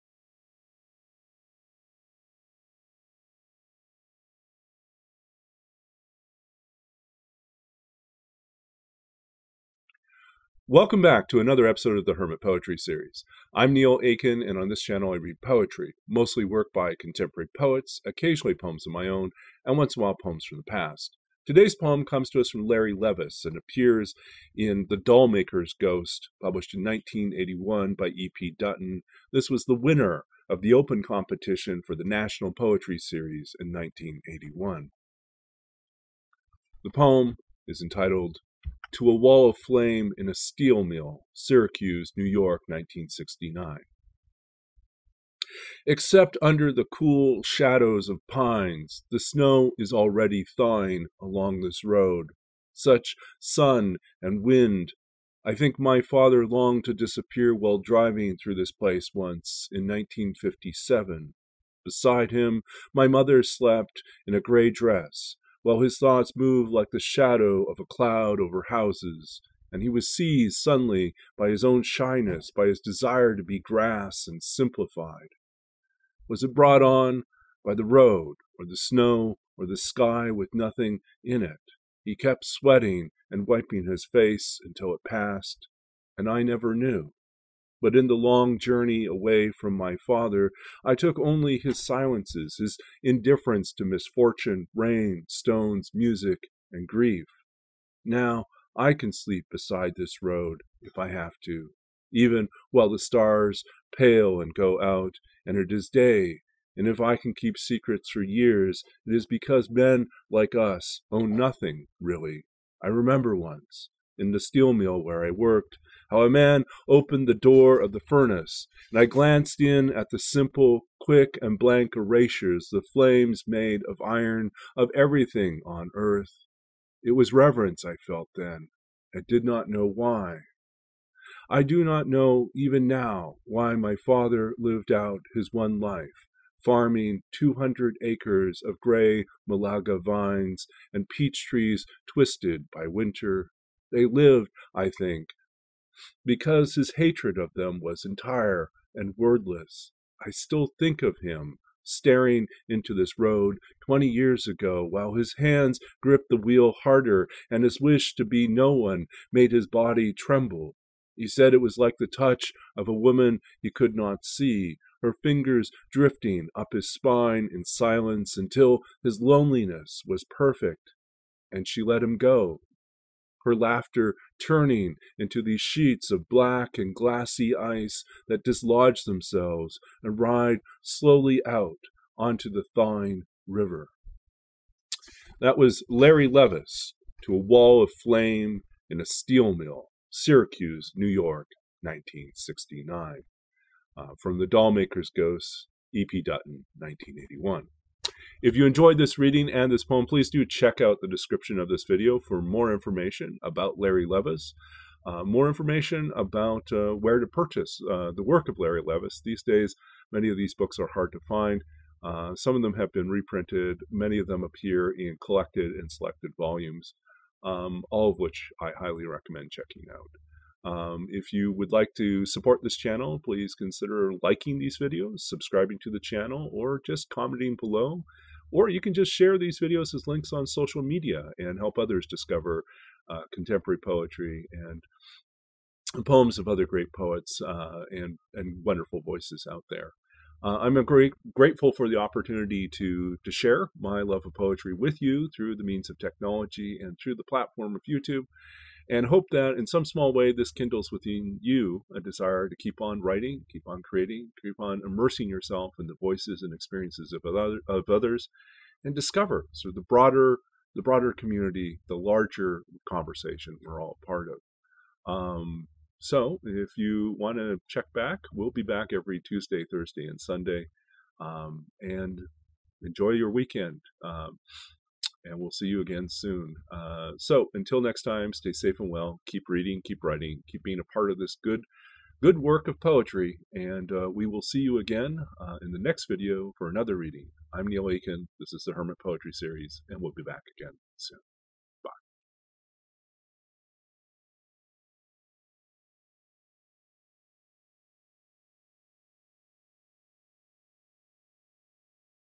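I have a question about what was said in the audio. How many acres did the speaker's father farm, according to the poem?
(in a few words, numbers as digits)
200.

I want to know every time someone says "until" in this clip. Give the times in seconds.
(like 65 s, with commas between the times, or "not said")
84 s, 168 s, 277 s.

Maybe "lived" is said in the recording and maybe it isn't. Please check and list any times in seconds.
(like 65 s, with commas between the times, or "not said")
134 s, 144 s.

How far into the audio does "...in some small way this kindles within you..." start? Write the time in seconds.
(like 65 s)
249 s.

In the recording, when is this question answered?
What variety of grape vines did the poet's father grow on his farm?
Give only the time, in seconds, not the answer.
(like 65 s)
139 s.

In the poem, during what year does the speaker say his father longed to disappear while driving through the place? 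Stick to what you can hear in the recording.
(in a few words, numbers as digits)
1957.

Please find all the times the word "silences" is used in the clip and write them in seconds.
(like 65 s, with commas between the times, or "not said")
91 s, 167 s.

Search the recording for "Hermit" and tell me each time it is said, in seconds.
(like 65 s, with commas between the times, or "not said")
12 s, 288 s.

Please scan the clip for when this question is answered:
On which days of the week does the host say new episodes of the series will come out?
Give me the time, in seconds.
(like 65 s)
269 s.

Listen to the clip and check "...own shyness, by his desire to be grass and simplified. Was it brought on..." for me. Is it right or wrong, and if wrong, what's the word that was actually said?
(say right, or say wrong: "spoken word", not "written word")
right.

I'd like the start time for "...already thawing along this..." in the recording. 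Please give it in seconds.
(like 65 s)
49 s.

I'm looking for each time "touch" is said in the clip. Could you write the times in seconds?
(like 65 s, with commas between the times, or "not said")
162 s.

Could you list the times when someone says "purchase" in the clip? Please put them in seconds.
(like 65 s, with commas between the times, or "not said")
207 s.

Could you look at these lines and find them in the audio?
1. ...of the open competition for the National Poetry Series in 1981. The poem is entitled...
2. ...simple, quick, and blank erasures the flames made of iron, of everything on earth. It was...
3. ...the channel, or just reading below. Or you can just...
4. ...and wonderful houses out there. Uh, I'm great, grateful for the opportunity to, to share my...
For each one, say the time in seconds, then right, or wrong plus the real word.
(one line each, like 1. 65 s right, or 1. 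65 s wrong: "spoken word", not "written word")
1. 30 s right
2. 120 s right
3. 225 s wrong: "commenting", not "reading"
4. 238 s wrong: "voices", not "houses".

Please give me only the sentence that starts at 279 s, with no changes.
Keep reading, keep writing, keep being a part of this good, good work of poetry.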